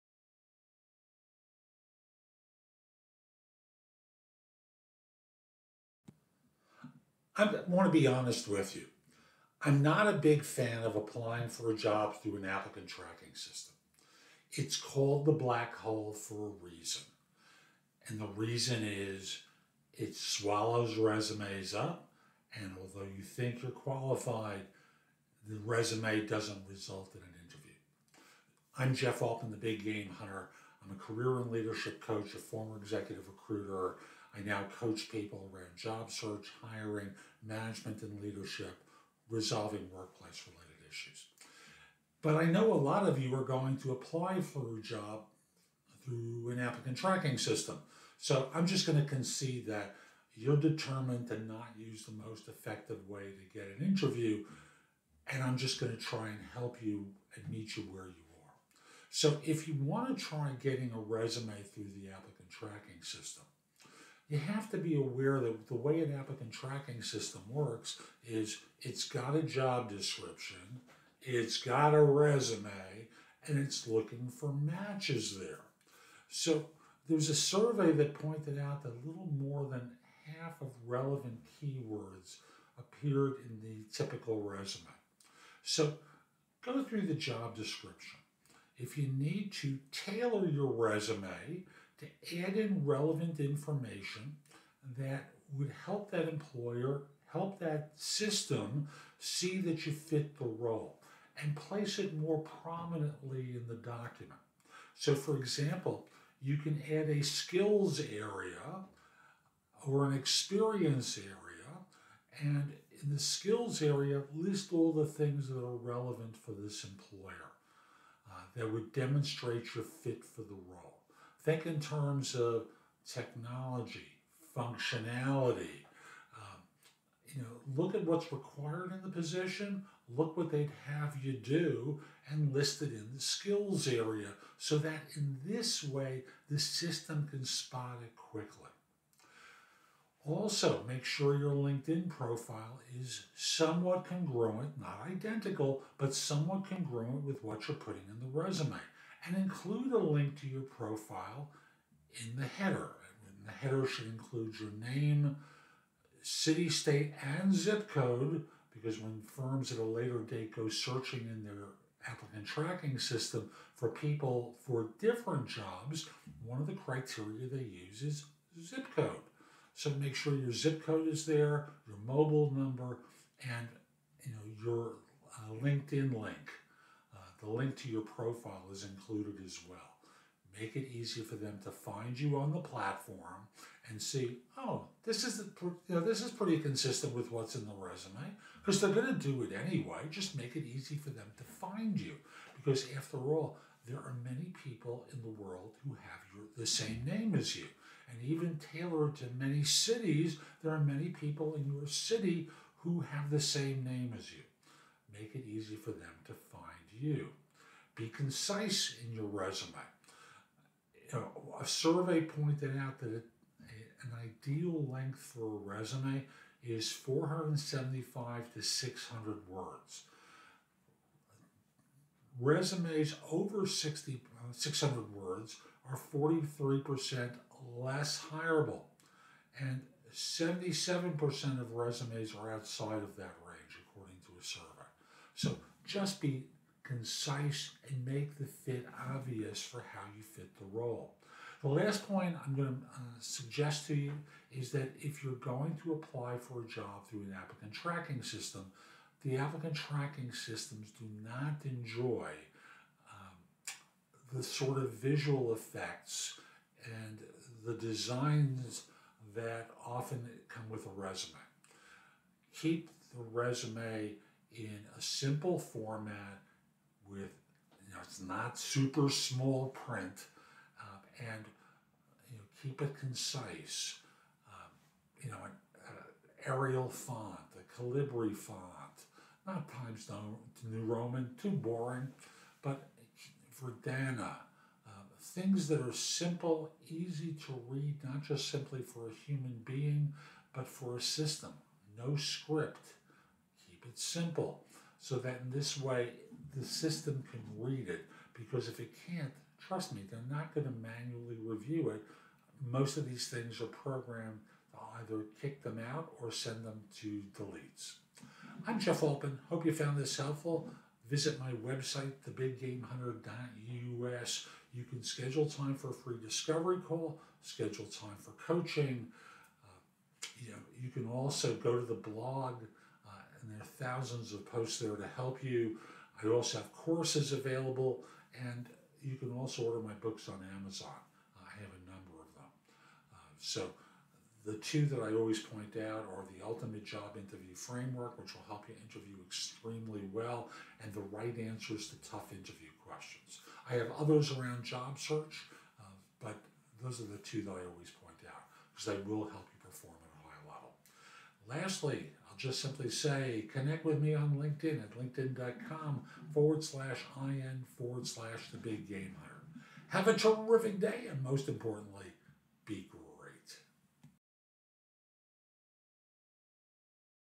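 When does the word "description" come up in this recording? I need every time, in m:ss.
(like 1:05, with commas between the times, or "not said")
1:09, 1:27.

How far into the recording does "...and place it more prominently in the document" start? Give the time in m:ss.
1:41.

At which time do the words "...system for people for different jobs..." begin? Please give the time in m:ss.
2:42.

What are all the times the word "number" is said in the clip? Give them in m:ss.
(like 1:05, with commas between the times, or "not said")
2:52, 5:31.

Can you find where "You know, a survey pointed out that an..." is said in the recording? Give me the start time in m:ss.
3:31.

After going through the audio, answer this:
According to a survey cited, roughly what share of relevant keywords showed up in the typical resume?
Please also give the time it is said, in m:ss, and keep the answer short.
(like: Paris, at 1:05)
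little more than half, at 1:19.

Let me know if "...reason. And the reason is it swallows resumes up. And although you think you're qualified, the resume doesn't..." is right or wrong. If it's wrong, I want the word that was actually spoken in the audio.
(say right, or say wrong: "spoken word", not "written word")
right.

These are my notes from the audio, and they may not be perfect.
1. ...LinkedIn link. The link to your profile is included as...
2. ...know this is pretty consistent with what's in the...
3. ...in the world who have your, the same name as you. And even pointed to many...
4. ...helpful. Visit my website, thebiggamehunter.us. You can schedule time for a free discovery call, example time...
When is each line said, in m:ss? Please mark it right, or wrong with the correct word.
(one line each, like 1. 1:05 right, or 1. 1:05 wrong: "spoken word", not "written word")
1. 2:55 right
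2. 3:05 right
3. 3:15 wrong: "tailored", not "pointed"
4. 5:10 wrong: "schedule", not "example".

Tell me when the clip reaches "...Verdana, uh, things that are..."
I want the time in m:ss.
4:43.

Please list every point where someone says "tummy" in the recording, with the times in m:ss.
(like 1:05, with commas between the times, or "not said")
not said.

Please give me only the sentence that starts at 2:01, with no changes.
Think in terms of technology, functionality.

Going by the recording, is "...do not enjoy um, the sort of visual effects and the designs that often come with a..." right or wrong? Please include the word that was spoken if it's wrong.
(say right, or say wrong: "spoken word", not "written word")
right.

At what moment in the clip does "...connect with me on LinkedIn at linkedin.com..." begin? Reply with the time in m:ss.
5:53.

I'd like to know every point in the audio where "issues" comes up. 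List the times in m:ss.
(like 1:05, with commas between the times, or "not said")
0:40.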